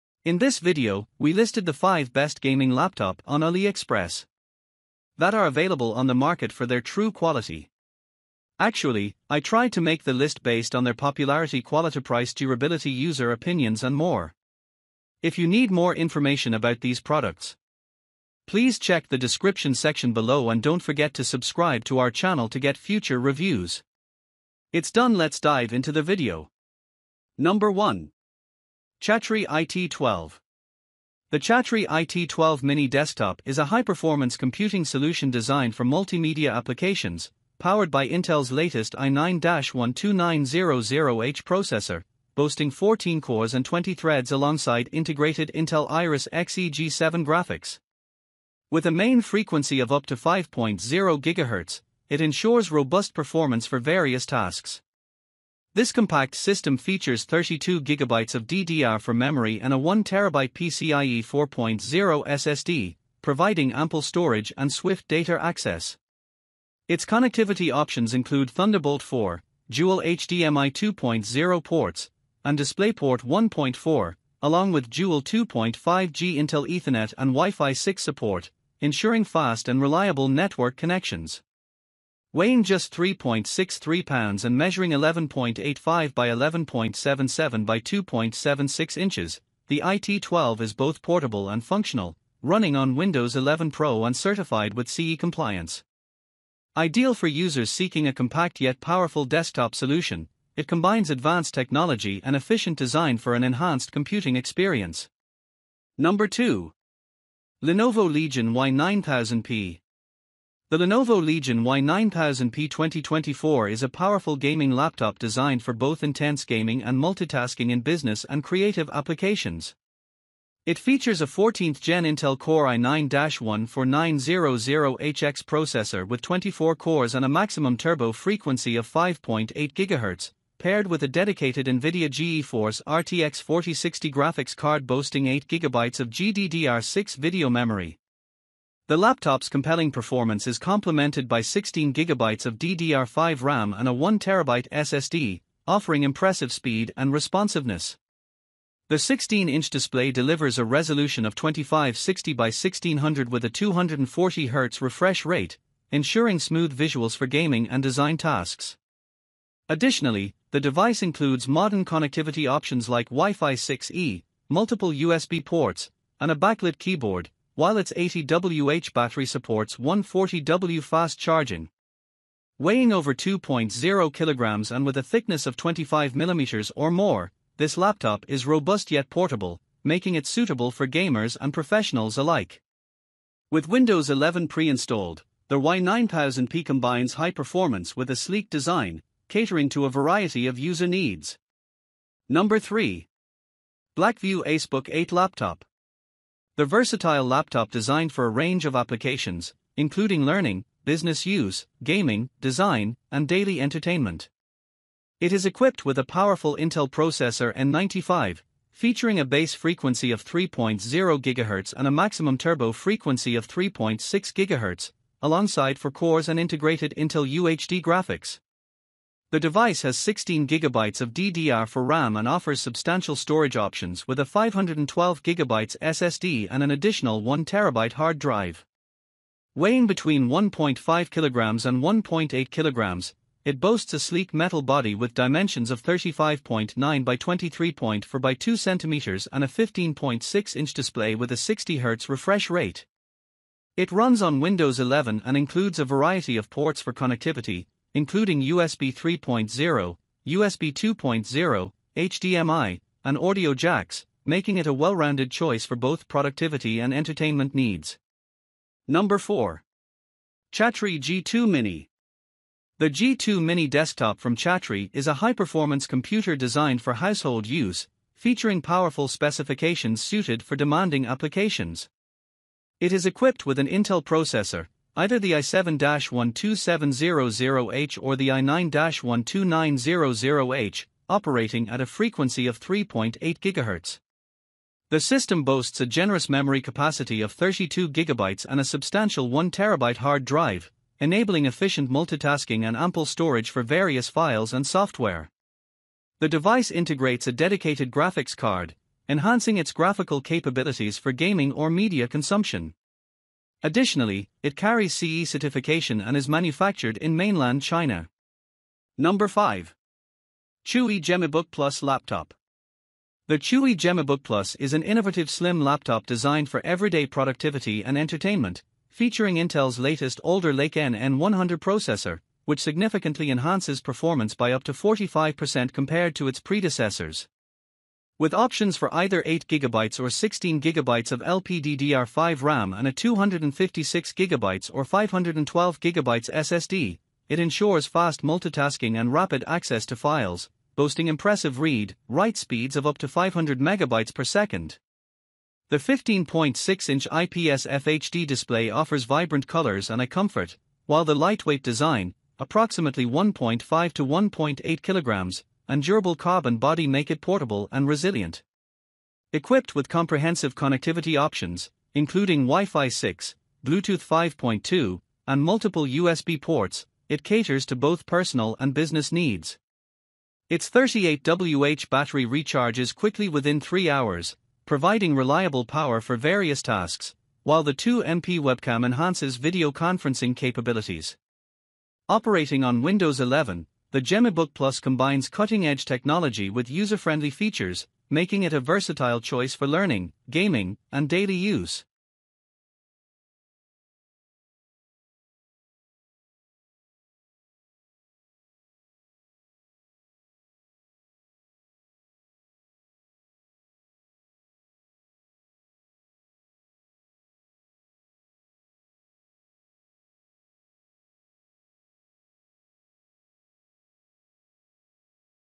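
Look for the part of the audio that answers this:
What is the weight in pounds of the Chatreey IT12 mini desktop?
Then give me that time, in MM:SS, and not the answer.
01:22.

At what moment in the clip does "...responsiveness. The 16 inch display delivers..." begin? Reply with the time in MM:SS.
02:27.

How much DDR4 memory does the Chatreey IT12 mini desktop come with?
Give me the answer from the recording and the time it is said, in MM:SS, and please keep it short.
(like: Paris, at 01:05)
32GB, at 00:57.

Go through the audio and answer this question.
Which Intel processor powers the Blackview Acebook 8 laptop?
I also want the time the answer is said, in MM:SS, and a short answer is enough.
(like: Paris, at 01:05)
Intel N95, at 03:27.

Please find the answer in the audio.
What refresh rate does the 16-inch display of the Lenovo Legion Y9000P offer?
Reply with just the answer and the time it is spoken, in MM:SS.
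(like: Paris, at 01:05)
240Hz, at 02:33.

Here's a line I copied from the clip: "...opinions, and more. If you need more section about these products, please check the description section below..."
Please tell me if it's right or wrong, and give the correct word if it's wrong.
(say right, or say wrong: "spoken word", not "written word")
wrong: "information", not "section".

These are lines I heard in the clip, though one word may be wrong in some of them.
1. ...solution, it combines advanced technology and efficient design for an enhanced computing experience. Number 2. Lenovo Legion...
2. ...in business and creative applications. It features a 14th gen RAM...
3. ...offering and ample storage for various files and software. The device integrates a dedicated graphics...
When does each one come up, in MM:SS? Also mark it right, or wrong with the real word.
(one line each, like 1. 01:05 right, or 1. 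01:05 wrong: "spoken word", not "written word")
1. 01:39 right
2. 01:57 wrong: "Intel", not "RAM"
3. 04:51 wrong: "multitasking", not "offering".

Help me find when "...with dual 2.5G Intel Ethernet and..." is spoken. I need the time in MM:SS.
01:14.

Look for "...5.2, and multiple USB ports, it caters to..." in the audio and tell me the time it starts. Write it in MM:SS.
06:04.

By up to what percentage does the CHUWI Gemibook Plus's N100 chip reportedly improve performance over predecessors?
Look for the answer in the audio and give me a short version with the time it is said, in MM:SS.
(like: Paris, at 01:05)
45%, at 05:24.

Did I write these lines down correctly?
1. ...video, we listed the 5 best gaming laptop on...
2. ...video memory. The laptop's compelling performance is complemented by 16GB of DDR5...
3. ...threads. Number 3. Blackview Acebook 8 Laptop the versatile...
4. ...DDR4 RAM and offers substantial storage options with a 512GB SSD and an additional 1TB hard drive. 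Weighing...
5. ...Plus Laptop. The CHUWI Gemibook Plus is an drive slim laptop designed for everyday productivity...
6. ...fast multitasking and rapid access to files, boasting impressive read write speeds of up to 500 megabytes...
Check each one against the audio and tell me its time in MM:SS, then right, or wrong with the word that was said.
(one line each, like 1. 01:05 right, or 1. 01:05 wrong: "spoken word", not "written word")
1. 00:00 right
2. 02:17 right
3. 03:10 wrong: "needs", not "threads"
4. 03:41 right
5. 05:11 wrong: "innovative", not "drive"
6. 05:37 right.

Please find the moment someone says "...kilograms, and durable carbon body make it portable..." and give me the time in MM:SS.
05:54.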